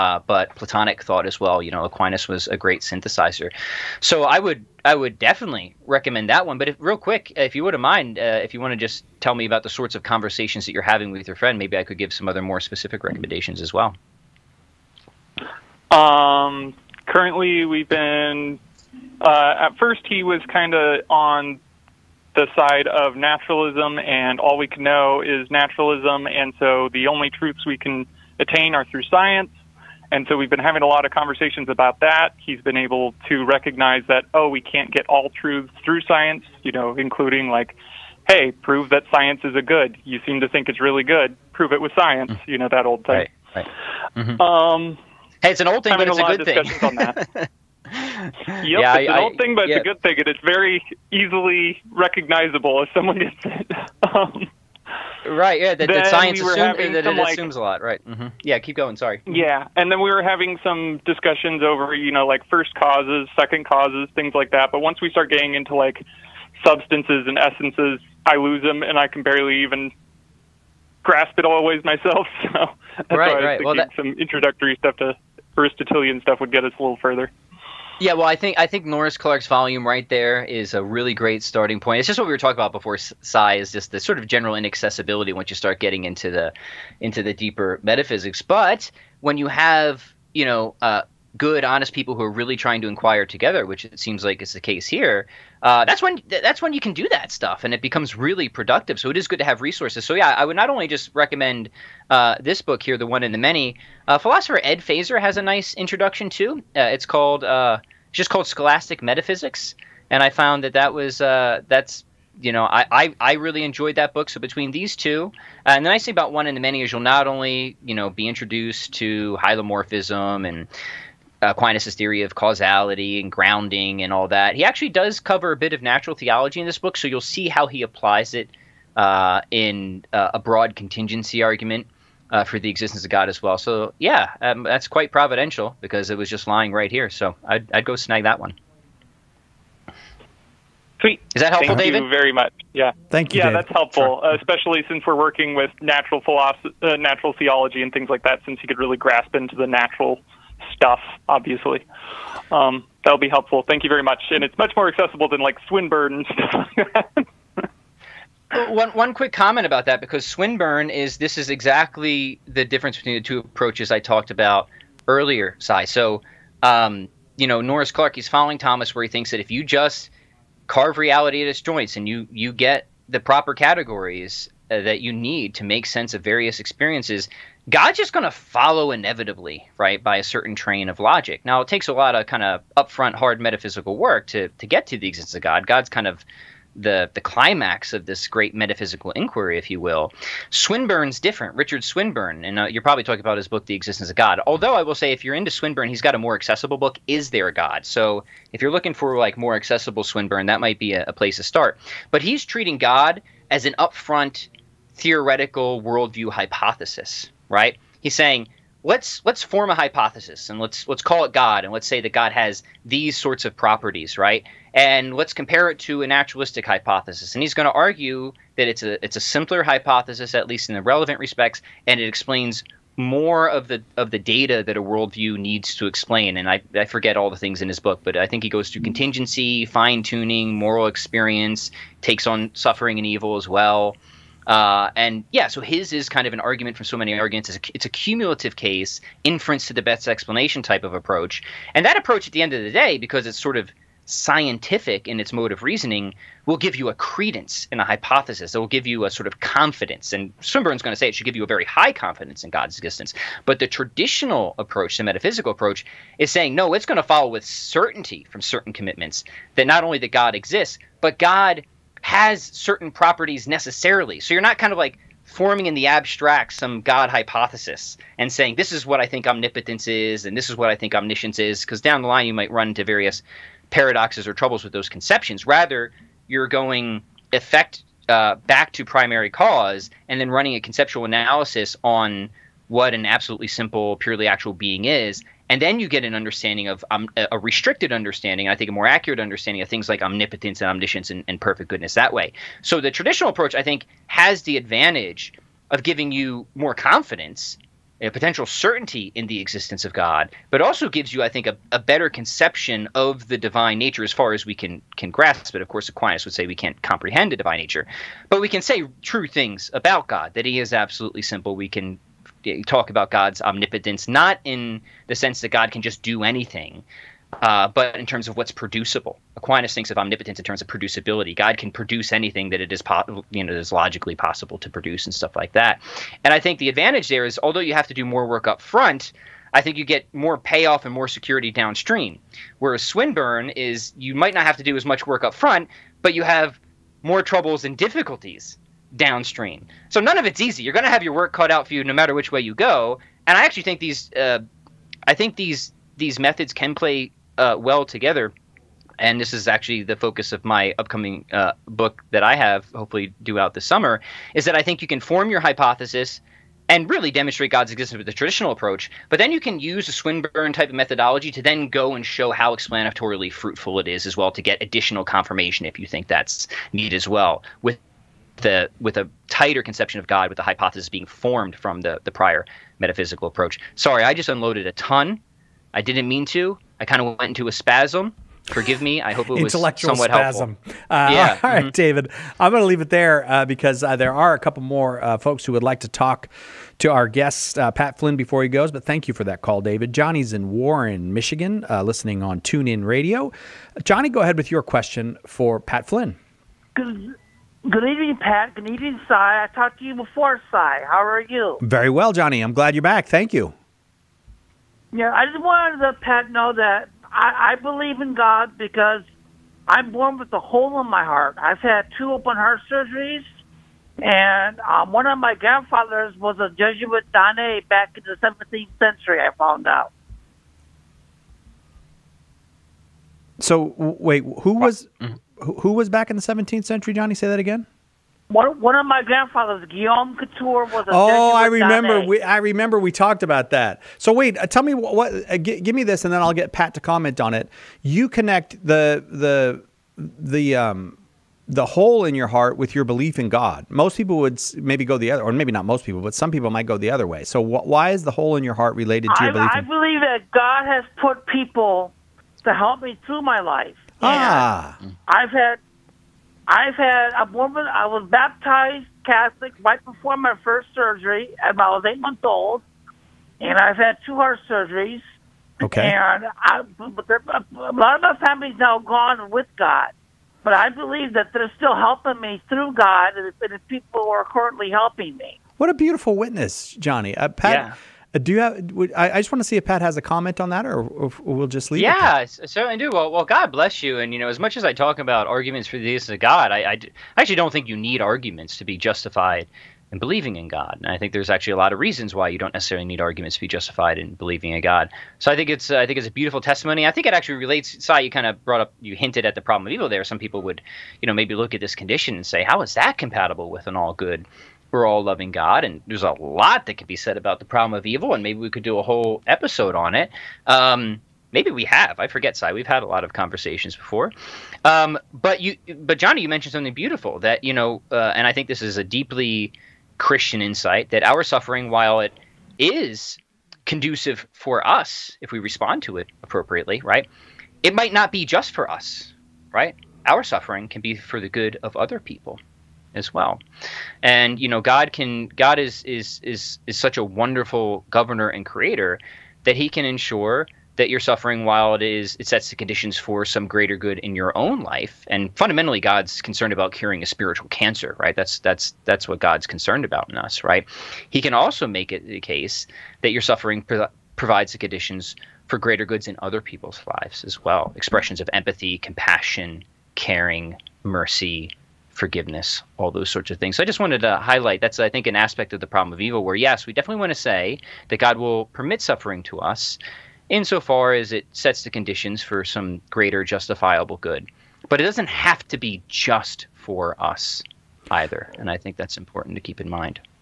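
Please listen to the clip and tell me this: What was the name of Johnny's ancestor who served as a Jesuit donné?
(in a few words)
Guillaume Couture.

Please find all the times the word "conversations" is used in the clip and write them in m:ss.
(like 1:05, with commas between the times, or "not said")
0:10, 0:31, 8:33.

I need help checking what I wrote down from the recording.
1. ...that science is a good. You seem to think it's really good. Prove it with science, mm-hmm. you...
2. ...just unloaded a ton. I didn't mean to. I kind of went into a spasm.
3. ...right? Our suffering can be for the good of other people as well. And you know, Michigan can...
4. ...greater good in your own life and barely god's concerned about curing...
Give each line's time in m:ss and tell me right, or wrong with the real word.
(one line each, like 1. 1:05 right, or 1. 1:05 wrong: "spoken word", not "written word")
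1. 0:38 right
2. 6:14 right
3. 8:49 wrong: "God", not "Michigan"
4. 9:03 wrong: "fundamentally", not "barely".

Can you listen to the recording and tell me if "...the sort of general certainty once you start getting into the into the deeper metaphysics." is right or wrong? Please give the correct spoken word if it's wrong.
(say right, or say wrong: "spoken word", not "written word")
wrong: "inaccessibility", not "certainty".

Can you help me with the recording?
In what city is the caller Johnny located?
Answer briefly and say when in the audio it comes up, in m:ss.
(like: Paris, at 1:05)
Warren, Michigan, at 6:30.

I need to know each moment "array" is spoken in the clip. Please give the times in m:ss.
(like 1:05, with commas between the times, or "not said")
not said.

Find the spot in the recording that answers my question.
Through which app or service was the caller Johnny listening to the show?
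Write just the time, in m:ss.
6:32.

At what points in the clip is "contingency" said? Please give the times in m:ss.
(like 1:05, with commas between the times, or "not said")
2:10, 3:48.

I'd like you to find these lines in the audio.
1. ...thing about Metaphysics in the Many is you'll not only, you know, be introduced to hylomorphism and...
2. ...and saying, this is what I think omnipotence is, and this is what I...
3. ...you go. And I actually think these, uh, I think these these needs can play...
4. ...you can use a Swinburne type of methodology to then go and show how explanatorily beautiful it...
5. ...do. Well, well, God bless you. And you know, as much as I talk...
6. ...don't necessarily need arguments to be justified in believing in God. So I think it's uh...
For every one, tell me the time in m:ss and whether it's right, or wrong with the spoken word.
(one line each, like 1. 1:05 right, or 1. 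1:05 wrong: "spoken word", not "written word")
1. 1:56 wrong: "One", not "Metaphysics"
2. 4:28 right
3. 5:42 wrong: "methods", not "needs"
4. 5:59 wrong: "fruitful", not "beautiful"
5. 8:02 right
6. 8:12 right.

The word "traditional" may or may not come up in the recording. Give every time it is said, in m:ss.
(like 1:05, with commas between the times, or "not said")
4:13, 4:52, 5:58.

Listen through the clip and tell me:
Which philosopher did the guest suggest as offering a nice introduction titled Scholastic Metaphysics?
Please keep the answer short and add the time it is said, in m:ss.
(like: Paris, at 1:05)
Ed Feser, at 1:44.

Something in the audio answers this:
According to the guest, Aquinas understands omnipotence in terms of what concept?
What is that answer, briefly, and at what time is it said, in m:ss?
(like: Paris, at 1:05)
Producibility, at 5:20.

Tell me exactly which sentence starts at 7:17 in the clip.
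You connect the the the um the hole in your heart with your belief in God.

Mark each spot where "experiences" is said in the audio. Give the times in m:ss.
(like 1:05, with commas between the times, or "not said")
2:56, 3:50.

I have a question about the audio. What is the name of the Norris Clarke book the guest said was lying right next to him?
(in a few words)
The One in the Many.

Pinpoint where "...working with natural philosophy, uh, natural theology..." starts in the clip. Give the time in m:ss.
2:25.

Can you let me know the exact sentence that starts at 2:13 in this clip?
So, yeah, um, that's quite providential because it was just lying right here.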